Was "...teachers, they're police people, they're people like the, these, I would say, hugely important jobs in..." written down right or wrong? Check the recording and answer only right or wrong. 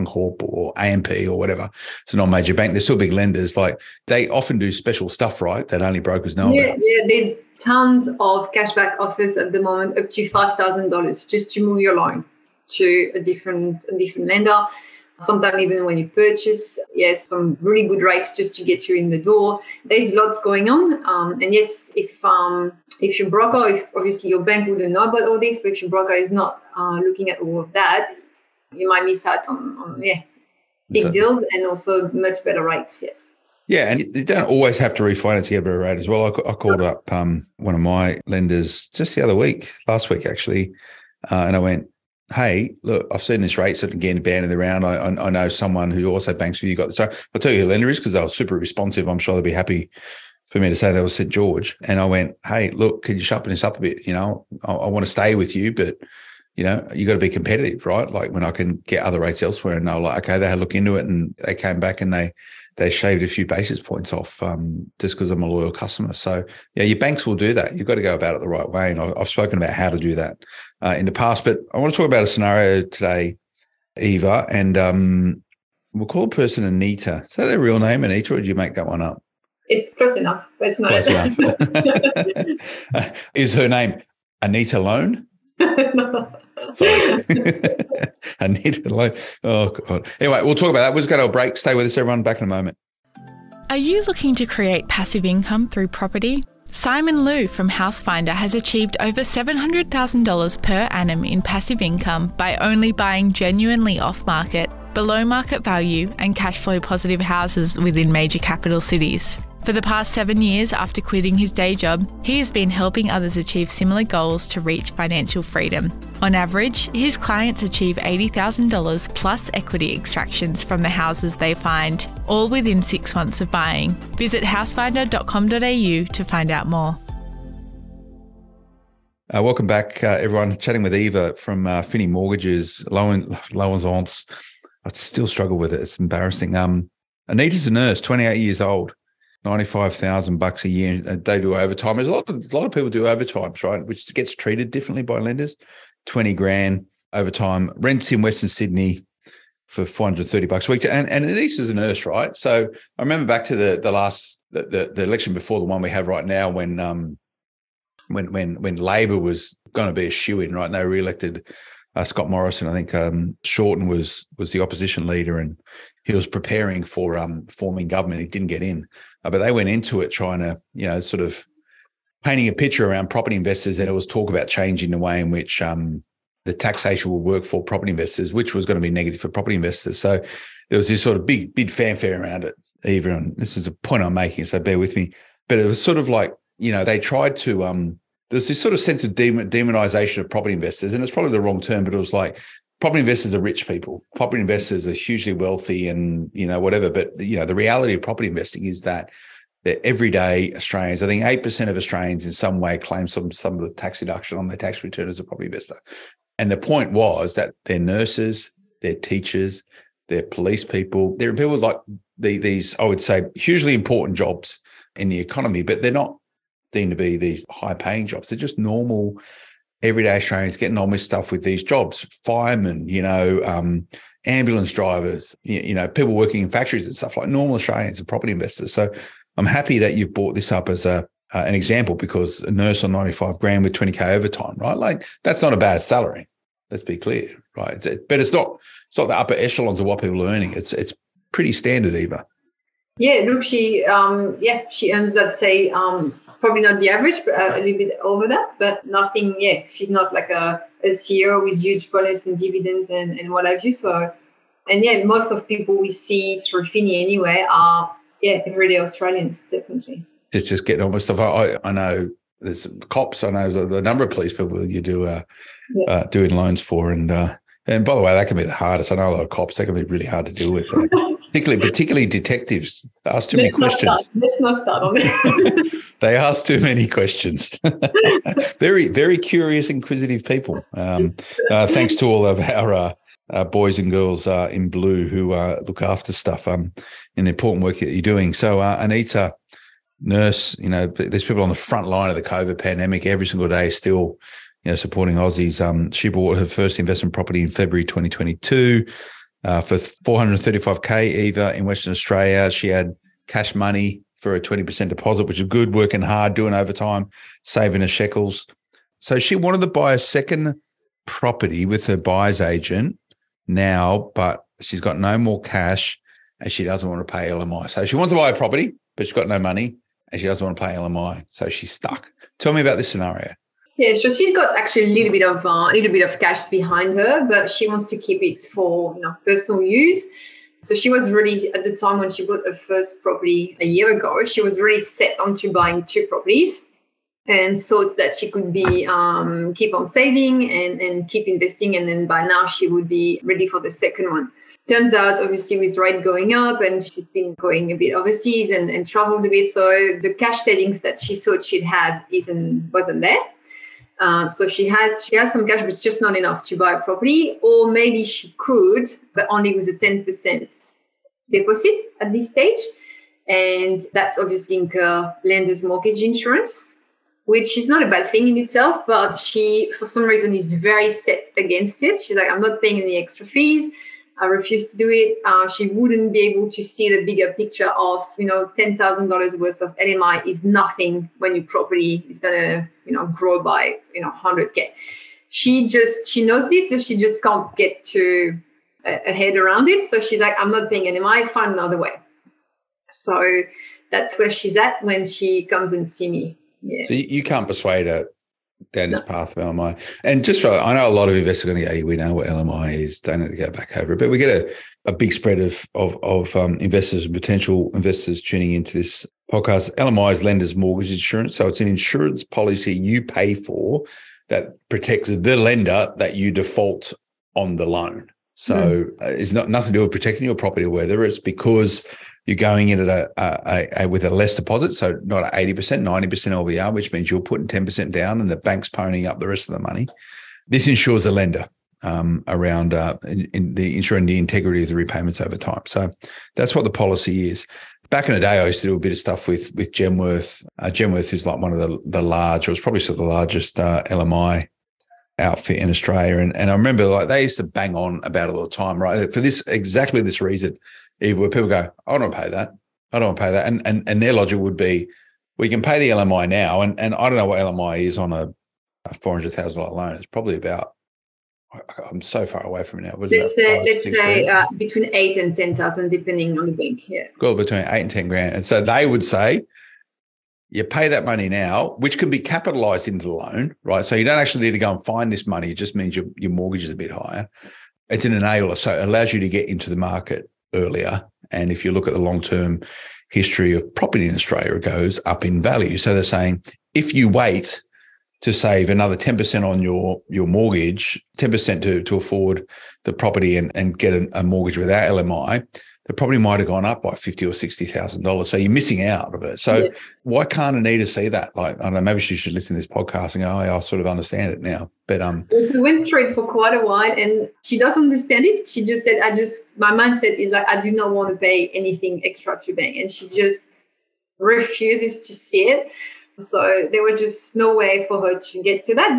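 right.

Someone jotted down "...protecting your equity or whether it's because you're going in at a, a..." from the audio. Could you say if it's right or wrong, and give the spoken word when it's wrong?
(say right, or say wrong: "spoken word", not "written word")
wrong: "property", not "equity".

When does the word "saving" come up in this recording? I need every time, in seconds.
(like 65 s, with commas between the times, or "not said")
307 s, 339 s, 350 s.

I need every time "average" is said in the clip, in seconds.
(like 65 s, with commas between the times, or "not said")
116 s, 246 s.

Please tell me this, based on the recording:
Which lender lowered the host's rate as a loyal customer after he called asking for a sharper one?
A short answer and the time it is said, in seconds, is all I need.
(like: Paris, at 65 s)
St George, at 51 s.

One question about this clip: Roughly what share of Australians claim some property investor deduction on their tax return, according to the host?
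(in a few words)
8%.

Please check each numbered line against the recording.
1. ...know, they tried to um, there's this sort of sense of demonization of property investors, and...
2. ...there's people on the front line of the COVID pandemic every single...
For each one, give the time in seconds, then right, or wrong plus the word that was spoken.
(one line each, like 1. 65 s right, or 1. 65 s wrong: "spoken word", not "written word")
1. 186 s right
2. 290 s right.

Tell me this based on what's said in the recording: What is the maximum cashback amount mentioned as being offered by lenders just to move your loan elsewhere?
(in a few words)
$5,000.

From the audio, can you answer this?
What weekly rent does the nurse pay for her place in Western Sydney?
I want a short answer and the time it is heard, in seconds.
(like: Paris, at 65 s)
$430, at 149 s.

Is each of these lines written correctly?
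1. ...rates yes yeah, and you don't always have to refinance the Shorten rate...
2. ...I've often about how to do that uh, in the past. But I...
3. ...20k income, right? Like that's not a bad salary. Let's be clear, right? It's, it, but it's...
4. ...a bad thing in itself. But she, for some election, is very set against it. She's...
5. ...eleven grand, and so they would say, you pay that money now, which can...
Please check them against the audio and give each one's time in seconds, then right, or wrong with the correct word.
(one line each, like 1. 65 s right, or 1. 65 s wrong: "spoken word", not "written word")
1. 32 s wrong: "EBRA", not "Shorten"
2. 69 s wrong: "spoken", not "often"
3. 233 s wrong: "overtime", not "income"
4. 367 s wrong: "reason", not "election"
5. 467 s wrong: "ten", not "eleven".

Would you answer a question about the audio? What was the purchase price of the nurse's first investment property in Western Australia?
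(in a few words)
$435,000.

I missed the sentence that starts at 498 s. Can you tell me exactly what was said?
So you're missing out of it.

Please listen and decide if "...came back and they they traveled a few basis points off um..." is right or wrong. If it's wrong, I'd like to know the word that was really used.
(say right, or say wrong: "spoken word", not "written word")
wrong: "shaved", not "traveled".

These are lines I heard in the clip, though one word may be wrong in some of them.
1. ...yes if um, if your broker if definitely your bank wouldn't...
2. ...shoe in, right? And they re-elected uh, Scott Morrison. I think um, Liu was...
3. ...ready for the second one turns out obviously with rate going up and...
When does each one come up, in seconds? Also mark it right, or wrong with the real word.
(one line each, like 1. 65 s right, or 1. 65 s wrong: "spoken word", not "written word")
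1. 21 s wrong: "obviously", not "definitely"
2. 160 s wrong: "Shorten", not "Liu"
3. 343 s right.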